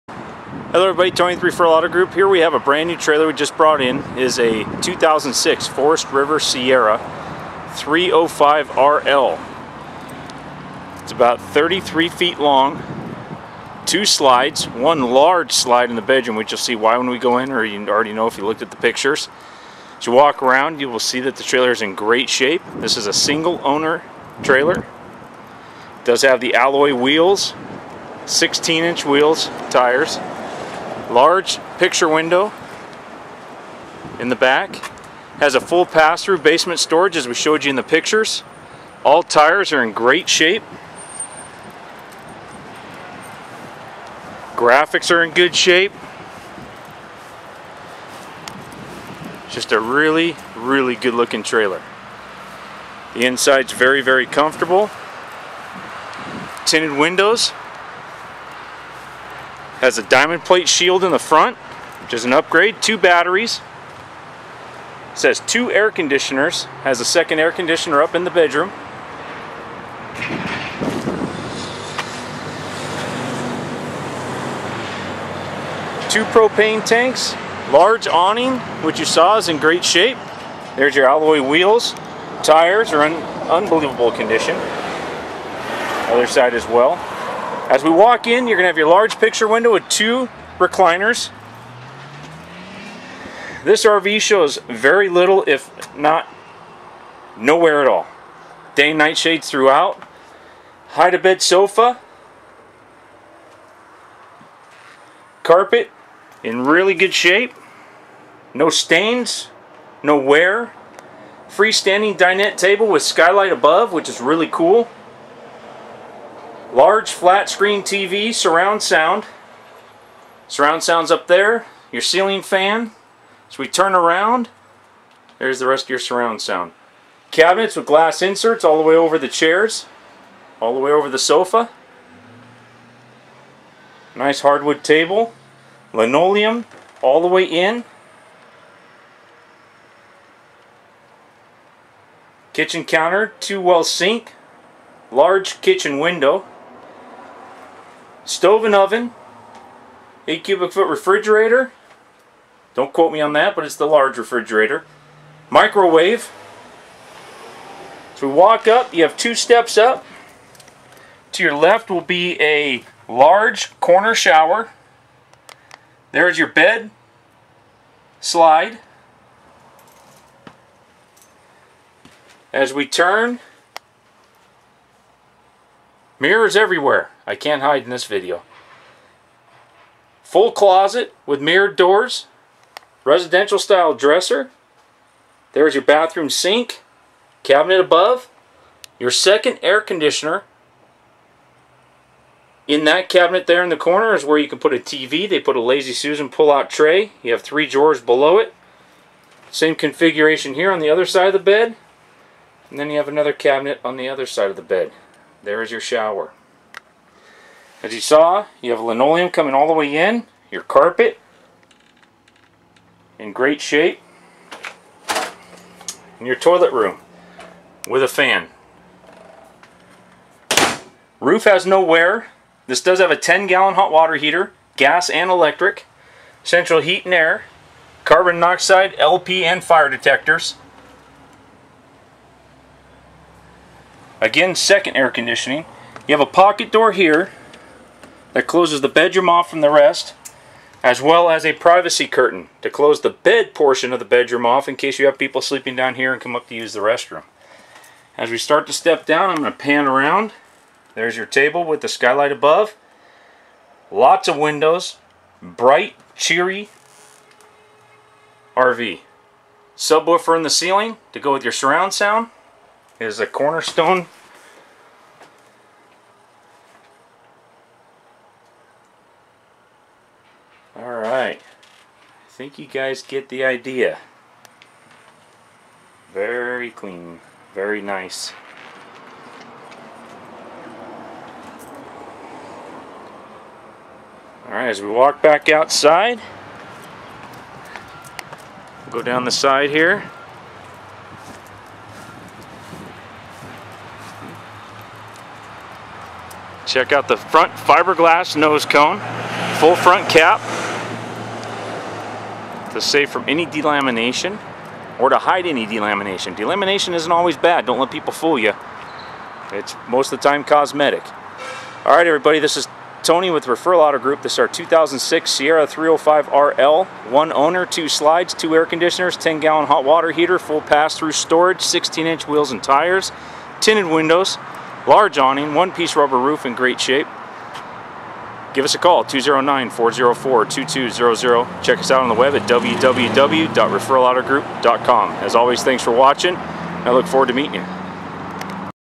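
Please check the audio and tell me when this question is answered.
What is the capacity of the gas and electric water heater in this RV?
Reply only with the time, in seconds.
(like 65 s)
223 s.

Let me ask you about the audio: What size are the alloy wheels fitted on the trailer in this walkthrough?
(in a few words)
16 inch.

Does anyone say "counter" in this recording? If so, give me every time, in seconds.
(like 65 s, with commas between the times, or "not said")
142 s.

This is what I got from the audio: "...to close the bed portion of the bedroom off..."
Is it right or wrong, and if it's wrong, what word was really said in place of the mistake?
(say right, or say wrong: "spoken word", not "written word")
right.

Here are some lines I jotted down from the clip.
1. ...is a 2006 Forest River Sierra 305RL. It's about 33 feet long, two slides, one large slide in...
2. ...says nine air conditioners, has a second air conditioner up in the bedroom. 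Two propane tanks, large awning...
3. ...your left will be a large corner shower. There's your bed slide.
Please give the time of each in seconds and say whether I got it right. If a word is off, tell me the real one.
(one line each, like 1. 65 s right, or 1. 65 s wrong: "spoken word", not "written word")
1. 4 s right
2. 65 s wrong: "two", not "nine"
3. 161 s right.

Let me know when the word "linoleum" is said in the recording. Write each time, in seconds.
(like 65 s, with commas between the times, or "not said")
135 s, 208 s.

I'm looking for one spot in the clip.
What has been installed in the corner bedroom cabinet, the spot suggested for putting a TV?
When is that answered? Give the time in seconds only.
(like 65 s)
195 s.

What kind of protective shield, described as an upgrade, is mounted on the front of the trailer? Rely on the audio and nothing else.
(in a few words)
Diamond plate.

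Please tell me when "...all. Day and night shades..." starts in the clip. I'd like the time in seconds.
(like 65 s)
97 s.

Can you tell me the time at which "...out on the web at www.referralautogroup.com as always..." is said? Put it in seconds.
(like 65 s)
331 s.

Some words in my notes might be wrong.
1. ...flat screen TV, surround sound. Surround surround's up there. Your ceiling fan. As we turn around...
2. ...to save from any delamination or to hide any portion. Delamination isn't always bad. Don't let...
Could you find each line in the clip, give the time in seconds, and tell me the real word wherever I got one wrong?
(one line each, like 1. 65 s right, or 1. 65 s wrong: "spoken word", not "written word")
1. 117 s wrong: "sound", not "surround"
2. 302 s wrong: "delamination", not "portion".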